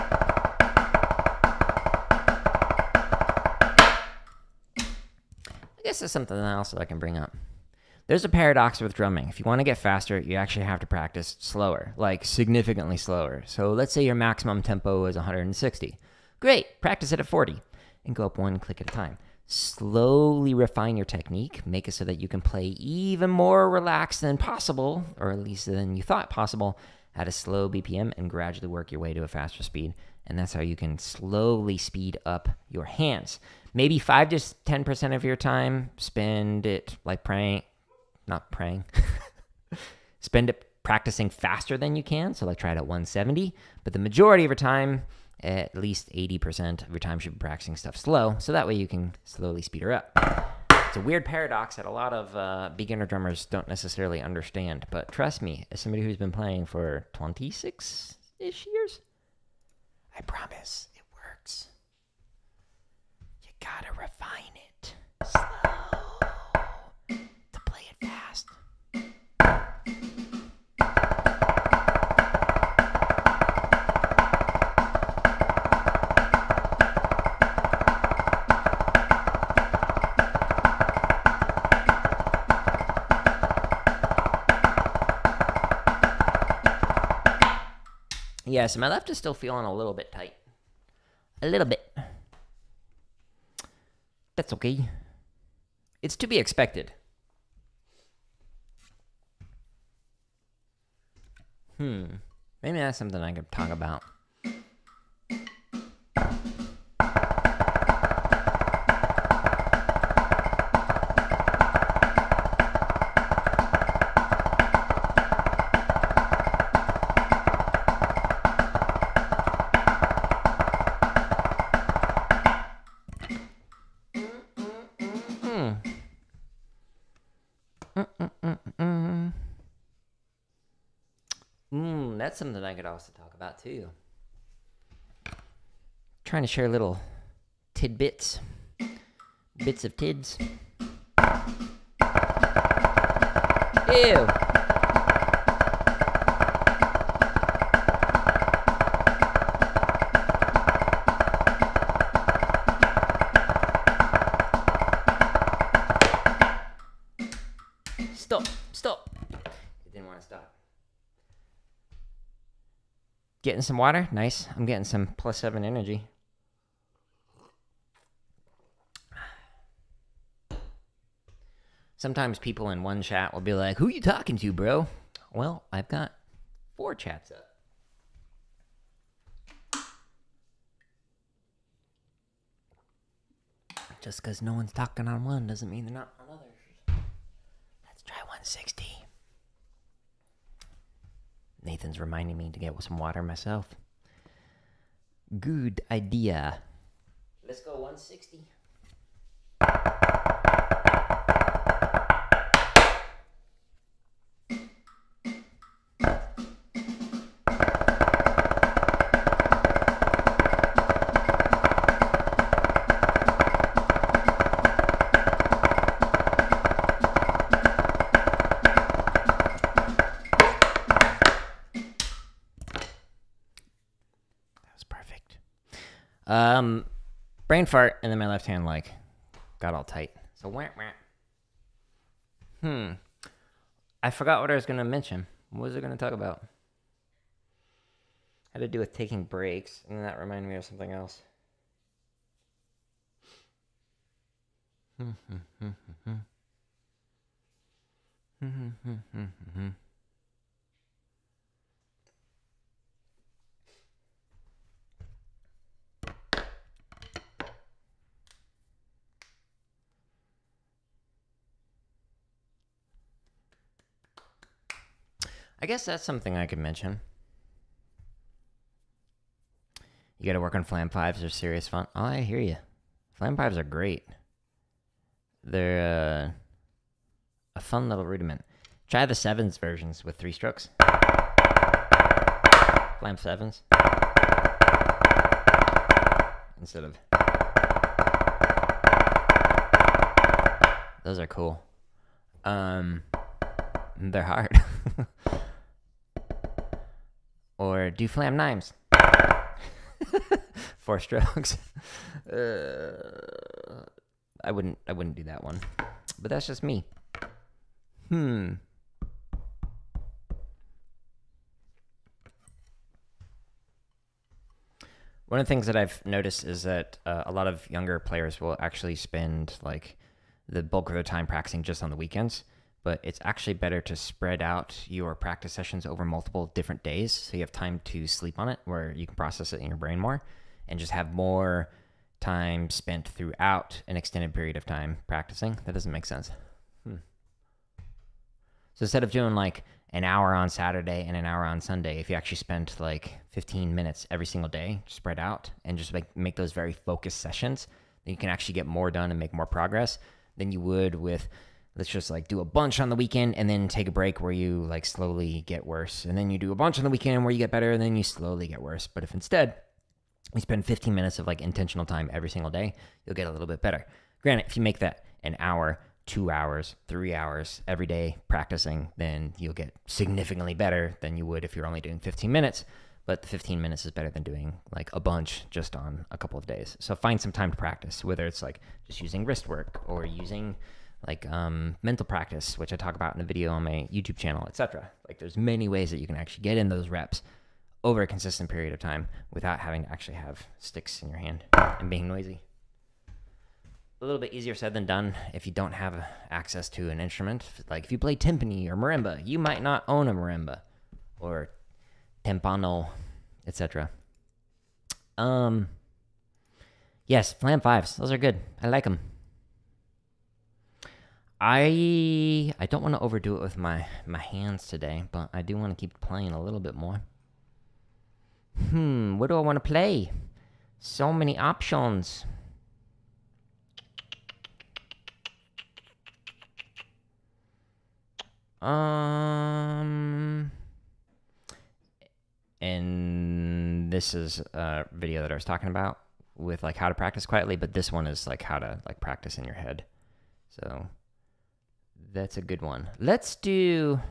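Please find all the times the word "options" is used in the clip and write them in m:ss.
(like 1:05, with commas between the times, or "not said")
7:01.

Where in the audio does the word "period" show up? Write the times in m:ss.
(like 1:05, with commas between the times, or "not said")
5:34, 6:28.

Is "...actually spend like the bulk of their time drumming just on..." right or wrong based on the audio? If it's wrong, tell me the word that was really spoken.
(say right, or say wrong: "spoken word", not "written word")
wrong: "practicing", not "drumming".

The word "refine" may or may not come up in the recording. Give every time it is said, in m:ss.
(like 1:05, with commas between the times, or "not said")
0:20, 1:03.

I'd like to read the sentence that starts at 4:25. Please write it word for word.
I guess that's something I could mention.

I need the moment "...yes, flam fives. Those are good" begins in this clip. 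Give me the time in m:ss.
6:47.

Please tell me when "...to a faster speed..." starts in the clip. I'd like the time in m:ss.
0:29.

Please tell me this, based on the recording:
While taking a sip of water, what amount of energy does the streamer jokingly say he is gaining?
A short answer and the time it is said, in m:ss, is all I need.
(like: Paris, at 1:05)
plus 7, at 2:45.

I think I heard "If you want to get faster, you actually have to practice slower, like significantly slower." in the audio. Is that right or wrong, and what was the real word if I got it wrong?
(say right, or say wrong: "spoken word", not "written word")
right.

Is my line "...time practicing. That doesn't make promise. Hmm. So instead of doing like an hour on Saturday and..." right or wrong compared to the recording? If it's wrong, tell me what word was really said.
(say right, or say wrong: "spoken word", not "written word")
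wrong: "sense", not "promise".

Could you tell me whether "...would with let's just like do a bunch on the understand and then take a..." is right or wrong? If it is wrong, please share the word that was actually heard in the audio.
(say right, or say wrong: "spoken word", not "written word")
wrong: "weekend", not "understand".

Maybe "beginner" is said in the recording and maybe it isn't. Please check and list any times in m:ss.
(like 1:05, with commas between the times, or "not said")
0:52.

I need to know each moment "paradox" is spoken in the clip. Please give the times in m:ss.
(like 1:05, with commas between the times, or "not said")
0:08, 0:51.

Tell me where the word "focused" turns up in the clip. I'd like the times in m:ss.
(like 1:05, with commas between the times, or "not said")
5:46.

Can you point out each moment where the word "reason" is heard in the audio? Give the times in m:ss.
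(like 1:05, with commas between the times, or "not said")
not said.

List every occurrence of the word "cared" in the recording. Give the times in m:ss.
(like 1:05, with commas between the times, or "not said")
not said.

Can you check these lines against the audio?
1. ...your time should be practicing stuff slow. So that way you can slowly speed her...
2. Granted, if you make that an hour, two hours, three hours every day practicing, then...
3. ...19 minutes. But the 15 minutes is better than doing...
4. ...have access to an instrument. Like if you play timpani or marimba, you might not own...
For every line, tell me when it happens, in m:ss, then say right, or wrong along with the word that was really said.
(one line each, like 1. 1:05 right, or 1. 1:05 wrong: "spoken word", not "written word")
1. 0:46 right
2. 6:04 right
3. 6:11 wrong: "15", not "19"
4. 6:35 right.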